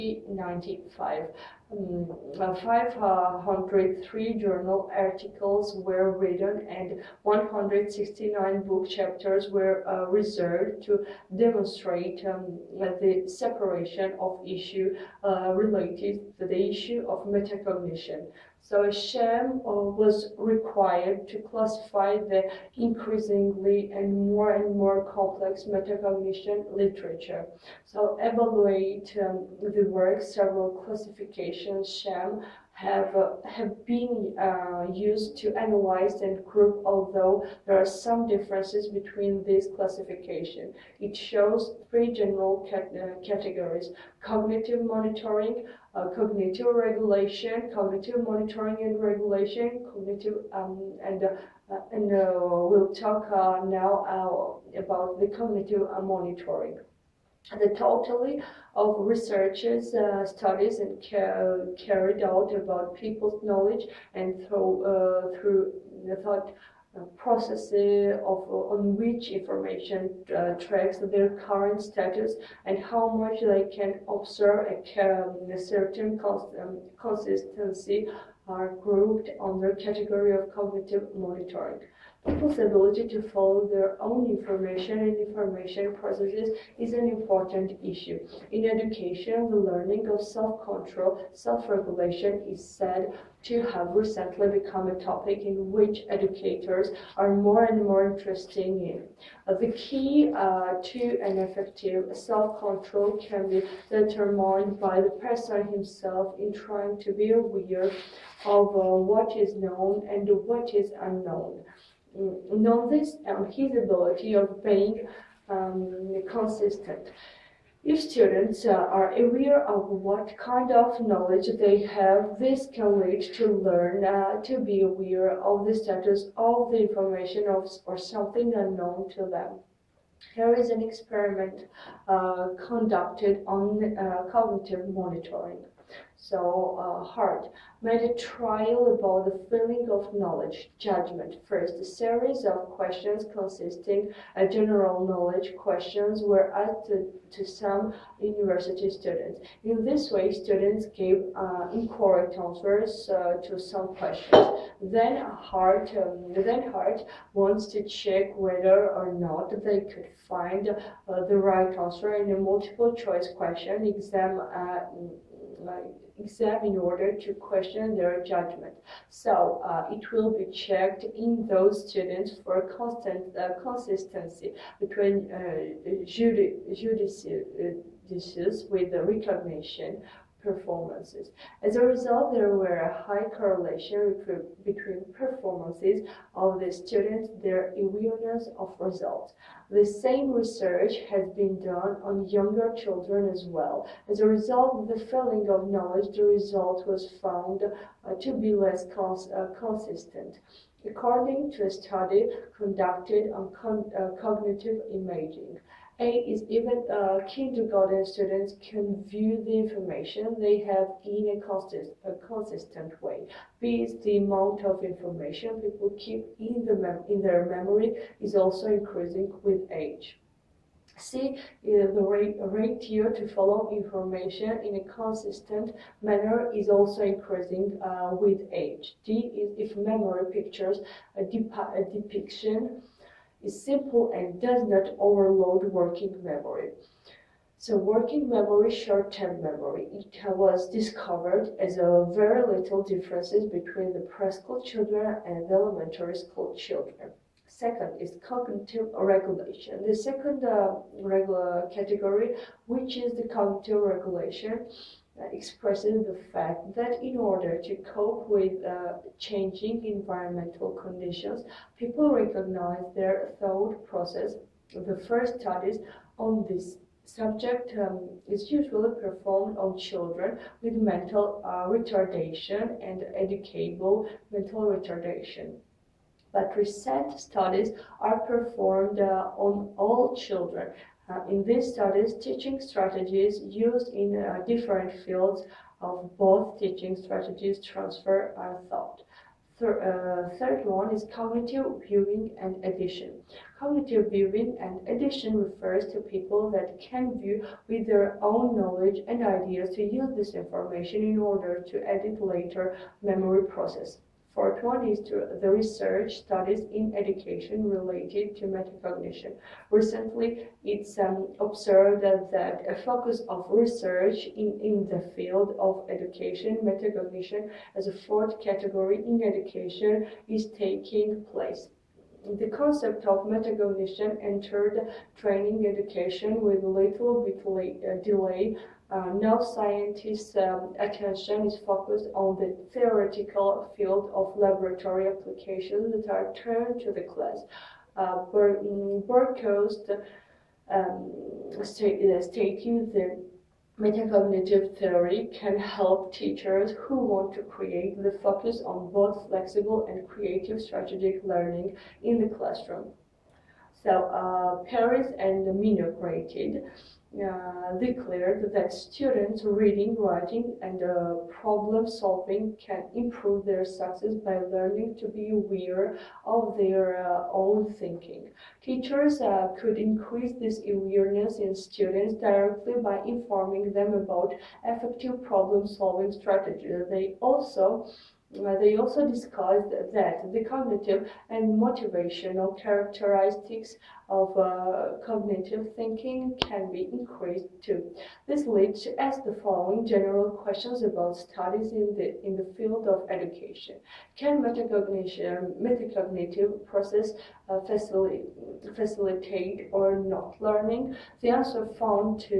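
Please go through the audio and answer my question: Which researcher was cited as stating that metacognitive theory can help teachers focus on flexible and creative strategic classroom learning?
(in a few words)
Burkhost.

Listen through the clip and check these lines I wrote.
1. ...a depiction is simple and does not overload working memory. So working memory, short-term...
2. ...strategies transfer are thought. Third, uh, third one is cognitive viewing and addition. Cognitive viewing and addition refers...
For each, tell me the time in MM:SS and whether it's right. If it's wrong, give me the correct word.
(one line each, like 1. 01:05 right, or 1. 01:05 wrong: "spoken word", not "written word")
1. 03:51 right
2. 04:46 right.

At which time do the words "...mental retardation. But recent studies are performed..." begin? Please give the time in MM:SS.
04:34.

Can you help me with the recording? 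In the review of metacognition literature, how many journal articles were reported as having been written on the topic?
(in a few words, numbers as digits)
503.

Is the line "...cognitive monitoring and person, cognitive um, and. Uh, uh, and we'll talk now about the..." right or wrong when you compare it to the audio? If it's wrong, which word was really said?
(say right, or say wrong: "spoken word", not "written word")
wrong: "regulation", not "person".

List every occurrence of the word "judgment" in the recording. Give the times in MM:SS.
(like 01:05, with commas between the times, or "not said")
02:20, 02:48.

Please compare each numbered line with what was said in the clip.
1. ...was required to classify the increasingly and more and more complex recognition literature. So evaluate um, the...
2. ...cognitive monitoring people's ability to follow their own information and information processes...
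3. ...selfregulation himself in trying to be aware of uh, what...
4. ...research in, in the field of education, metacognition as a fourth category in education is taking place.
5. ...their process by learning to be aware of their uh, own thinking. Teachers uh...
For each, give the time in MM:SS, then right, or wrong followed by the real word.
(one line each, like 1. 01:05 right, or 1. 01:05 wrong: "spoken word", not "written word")
1. 00:20 wrong: "metacognition", not "recognition"
2. 01:20 right
3. 01:45 wrong: "person", not "selfregulation"
4. 05:13 right
5. 06:03 wrong: "success", not "process".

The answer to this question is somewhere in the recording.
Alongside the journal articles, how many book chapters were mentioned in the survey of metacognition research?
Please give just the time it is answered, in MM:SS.
00:07.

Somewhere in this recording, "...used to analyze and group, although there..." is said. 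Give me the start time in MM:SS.
00:34.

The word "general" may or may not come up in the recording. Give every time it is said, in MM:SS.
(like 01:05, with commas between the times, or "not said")
00:42, 02:24, 06:29.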